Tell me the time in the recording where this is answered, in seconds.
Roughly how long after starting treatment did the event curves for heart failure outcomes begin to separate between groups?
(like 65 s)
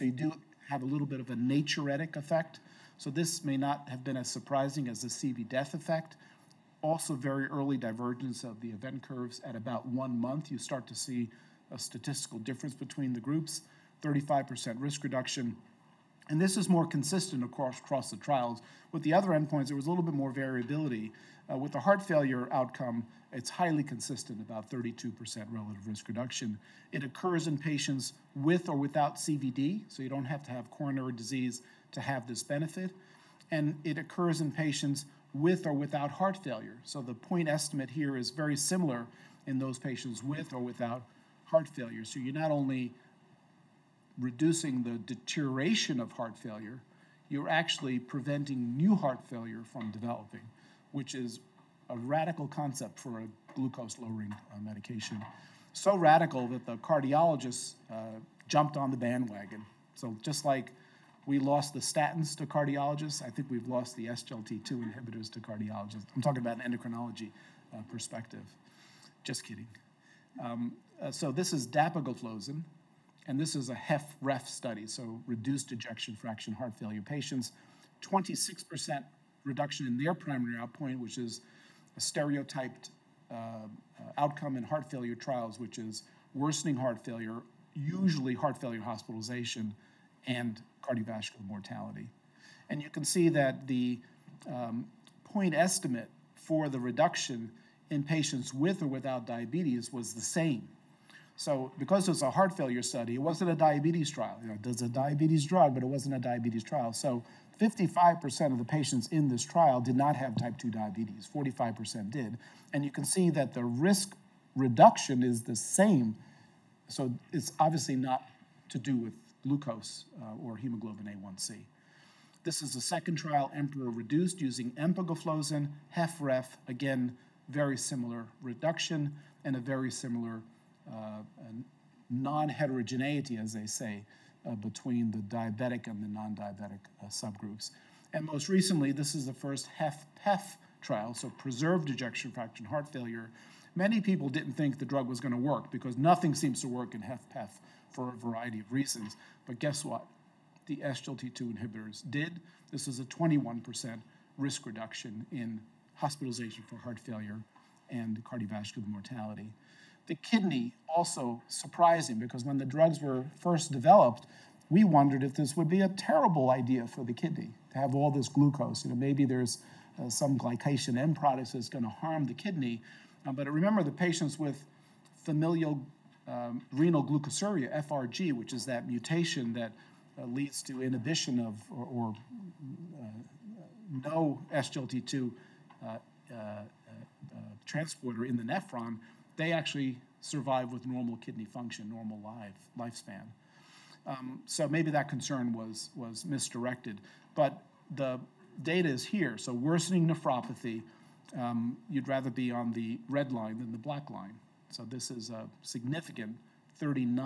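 9 s.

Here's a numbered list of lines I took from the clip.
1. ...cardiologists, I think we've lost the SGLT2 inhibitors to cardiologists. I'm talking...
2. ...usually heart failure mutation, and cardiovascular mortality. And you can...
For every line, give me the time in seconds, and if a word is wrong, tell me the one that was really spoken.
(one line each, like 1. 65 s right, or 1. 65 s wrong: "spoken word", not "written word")
1. 62 s right
2. 87 s wrong: "hospitalization", not "mutation".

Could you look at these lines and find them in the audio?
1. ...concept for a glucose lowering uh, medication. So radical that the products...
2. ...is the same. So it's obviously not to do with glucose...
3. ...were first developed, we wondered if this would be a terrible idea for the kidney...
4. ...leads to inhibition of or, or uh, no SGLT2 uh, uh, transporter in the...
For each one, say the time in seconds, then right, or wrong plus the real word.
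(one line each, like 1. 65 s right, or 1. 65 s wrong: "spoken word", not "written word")
1. 52 s wrong: "cardiologists", not "products"
2. 115 s right
3. 163 s right
4. 180 s right.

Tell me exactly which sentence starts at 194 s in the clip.
Um, so maybe that concern was was misdirected, but the data is here.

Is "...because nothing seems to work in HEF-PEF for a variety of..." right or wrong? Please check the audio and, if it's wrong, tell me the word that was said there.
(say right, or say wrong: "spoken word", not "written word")
right.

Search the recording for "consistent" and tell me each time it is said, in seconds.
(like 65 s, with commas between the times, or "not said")
16 s, 23 s.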